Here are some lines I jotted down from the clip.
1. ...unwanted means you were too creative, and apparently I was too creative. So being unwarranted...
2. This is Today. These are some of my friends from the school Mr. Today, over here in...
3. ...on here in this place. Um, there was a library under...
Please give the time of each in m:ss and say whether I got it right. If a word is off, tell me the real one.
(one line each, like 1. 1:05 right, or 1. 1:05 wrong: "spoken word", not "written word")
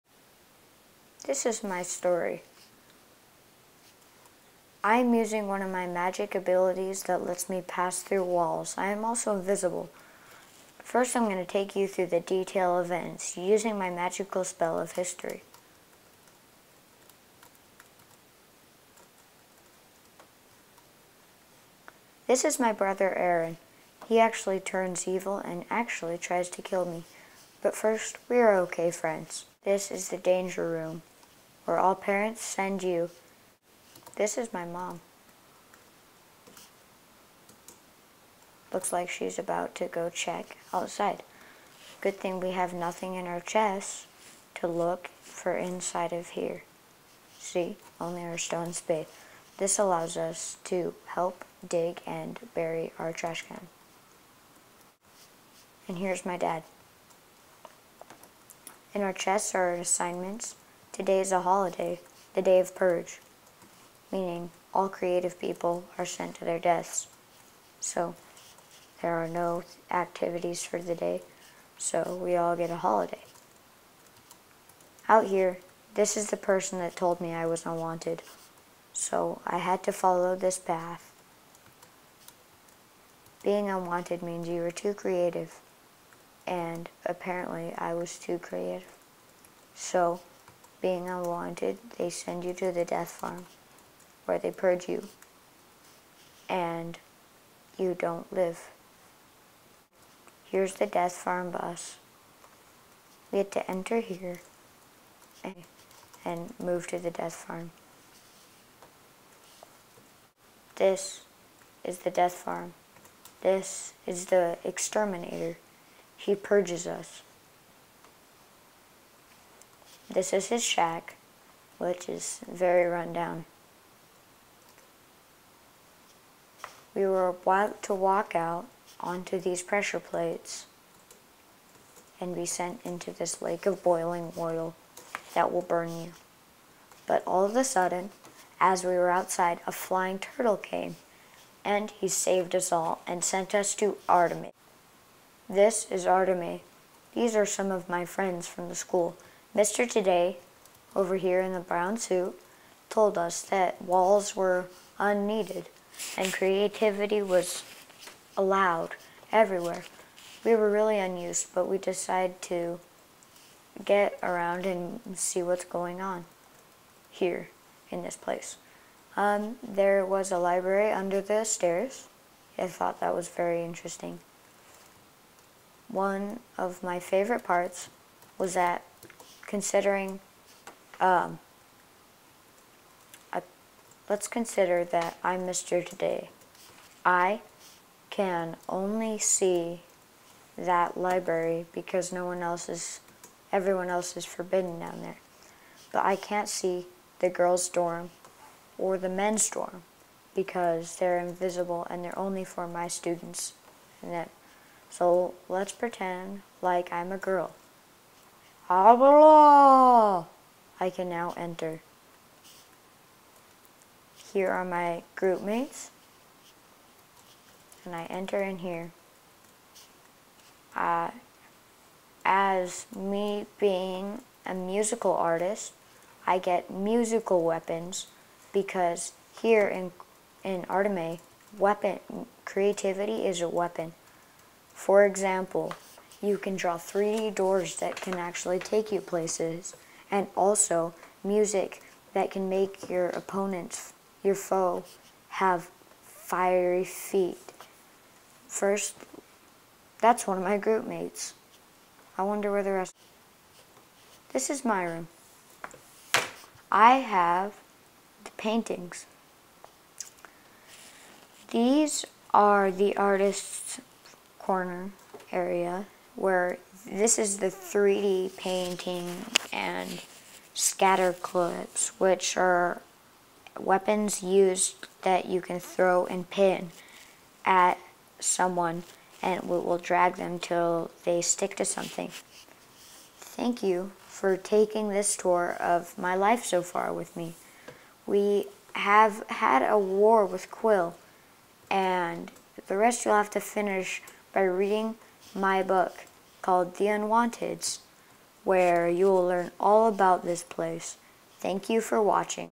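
1. 1:23 right
2. 2:25 wrong: "Artemis", not "Today"
3. 2:45 right.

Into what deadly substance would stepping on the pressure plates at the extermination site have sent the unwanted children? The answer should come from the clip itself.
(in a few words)
boiling oil.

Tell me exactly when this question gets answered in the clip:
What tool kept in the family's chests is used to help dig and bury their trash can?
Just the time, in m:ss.
0:48.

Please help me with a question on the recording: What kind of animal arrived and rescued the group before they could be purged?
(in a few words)
flying turtle.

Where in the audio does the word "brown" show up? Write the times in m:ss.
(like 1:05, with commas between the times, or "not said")
2:31.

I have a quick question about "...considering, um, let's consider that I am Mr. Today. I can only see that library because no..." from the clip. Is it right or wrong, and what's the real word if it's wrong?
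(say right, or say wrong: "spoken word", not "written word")
right.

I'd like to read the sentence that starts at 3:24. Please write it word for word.
And that, so let's pretend like I'm a girl Abala!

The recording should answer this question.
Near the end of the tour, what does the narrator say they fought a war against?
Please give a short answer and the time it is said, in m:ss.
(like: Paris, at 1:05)
Quill, at 4:50.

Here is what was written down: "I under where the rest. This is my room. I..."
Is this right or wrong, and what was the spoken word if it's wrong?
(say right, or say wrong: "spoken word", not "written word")
wrong: "wonder", not "under".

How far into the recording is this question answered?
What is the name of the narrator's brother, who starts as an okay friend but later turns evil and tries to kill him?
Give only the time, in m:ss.
0:23.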